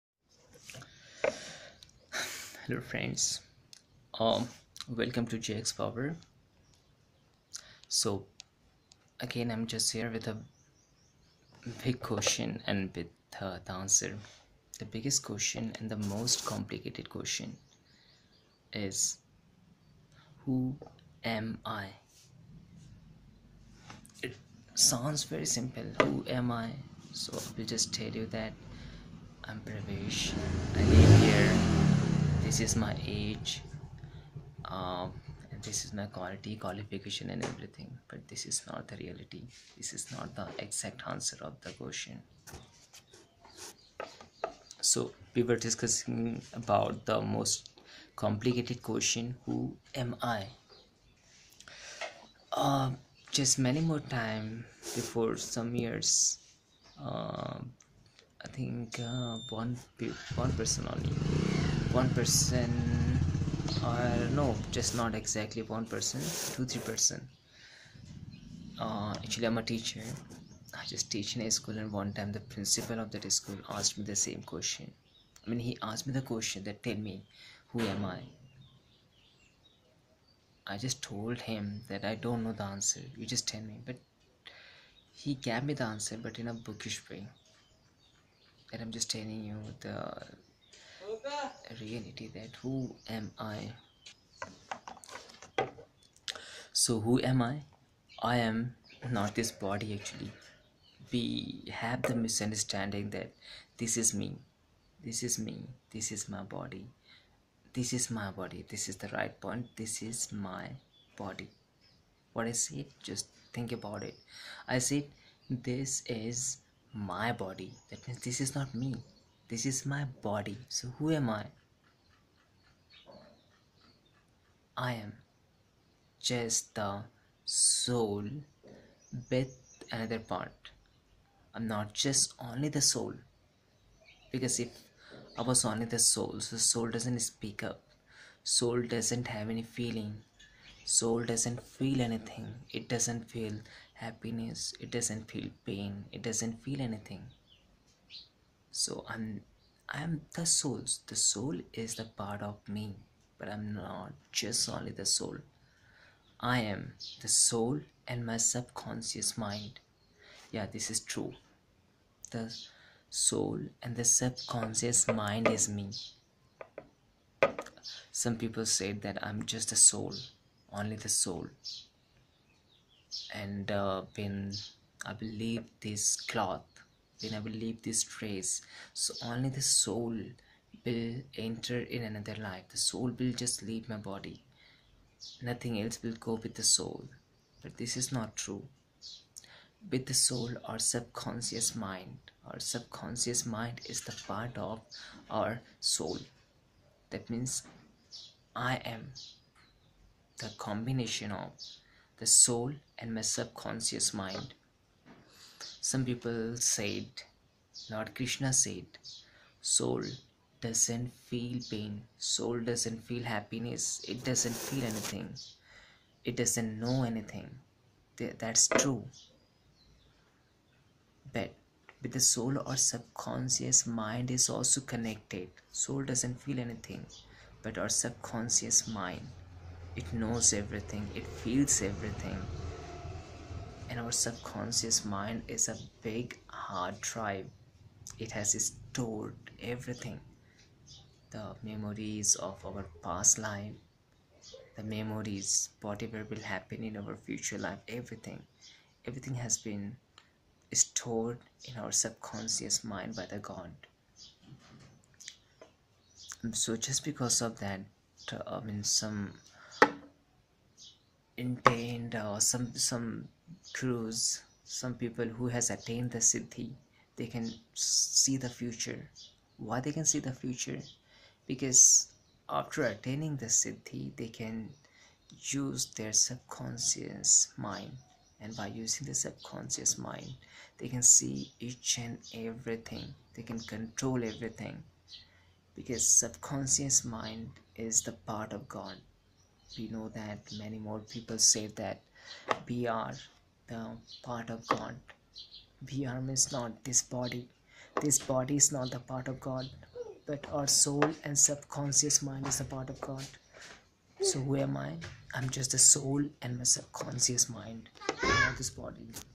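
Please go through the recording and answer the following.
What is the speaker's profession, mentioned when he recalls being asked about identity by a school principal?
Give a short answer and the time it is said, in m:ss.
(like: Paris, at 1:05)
Teacher, at 1:09.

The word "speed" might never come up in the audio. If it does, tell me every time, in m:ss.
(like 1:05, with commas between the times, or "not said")
not said.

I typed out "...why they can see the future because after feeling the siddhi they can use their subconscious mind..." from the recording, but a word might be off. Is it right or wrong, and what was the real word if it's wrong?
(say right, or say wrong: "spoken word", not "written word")
wrong: "attaining", not "feeling".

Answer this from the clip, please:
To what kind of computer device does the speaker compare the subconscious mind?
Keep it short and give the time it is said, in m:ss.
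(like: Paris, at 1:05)
Hard drive, at 3:56.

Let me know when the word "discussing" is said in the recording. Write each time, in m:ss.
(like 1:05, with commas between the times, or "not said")
0:45.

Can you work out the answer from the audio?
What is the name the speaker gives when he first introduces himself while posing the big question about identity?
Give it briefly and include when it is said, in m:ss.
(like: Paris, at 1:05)
Pravesh, at 0:29.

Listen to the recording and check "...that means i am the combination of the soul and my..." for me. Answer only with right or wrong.
right.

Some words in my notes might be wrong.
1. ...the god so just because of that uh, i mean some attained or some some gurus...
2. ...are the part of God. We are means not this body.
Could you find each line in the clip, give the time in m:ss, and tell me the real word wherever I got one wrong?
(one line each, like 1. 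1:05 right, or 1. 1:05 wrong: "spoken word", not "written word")
1. 4:13 right
2. 4:52 right.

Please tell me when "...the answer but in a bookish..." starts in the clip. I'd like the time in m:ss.
1:25.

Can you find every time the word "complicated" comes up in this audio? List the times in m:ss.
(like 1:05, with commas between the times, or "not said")
0:16, 0:48.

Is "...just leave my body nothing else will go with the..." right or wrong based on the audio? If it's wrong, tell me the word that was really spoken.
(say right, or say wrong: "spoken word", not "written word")
right.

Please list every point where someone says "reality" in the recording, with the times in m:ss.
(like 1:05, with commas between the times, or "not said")
0:38, 1:31.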